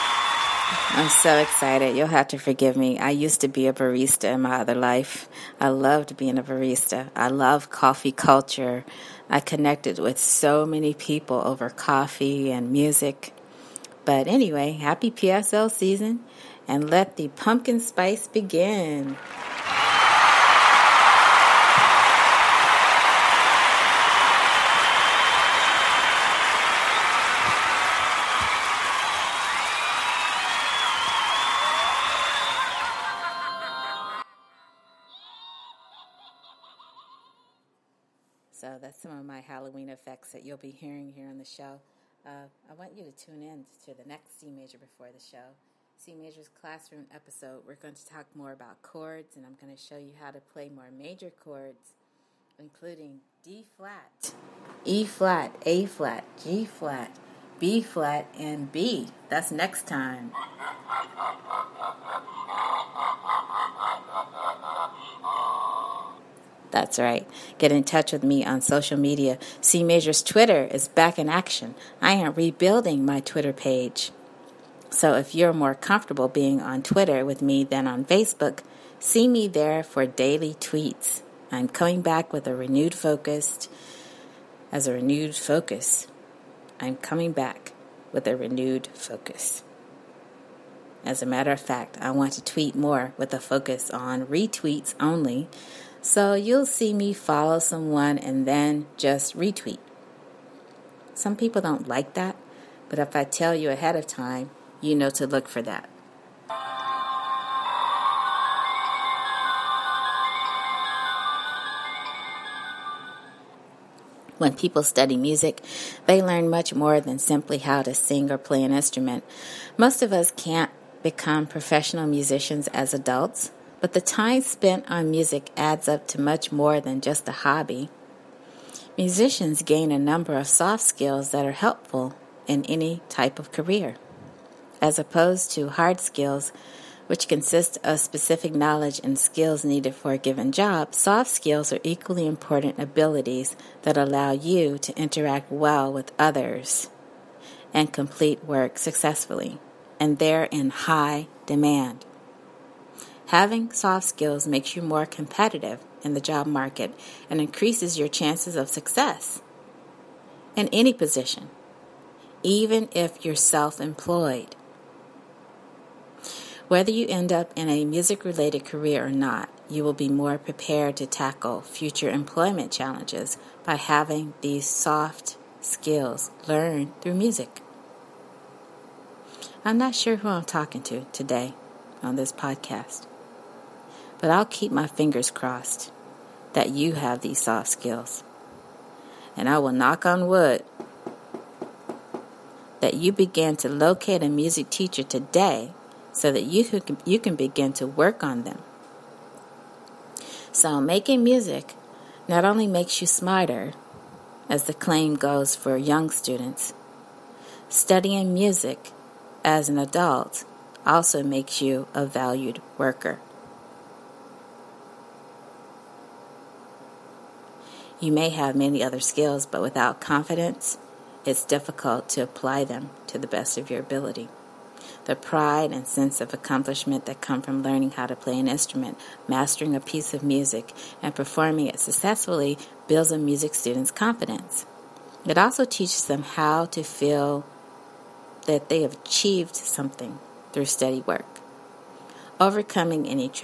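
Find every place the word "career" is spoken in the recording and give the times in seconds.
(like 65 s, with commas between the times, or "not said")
133 s, 168 s.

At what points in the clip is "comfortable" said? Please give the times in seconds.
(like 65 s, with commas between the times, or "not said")
75 s.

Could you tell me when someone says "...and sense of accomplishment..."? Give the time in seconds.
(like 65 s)
225 s.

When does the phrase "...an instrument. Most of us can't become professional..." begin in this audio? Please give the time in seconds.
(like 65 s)
118 s.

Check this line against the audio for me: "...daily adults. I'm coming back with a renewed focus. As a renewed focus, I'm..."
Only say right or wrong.
wrong.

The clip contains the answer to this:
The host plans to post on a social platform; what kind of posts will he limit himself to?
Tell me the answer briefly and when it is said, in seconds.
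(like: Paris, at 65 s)
retweets, at 94 s.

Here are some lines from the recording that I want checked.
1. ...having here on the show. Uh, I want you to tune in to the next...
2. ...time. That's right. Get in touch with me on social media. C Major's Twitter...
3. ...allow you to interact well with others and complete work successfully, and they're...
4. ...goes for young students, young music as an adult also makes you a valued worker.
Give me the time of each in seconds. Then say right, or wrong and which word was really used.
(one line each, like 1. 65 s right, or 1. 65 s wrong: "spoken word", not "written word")
1. 40 s wrong: "hearing", not "having"
2. 59 s right
3. 143 s right
4. 205 s wrong: "studying", not "young".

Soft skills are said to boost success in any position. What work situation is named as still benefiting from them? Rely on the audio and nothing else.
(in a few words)
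self employed.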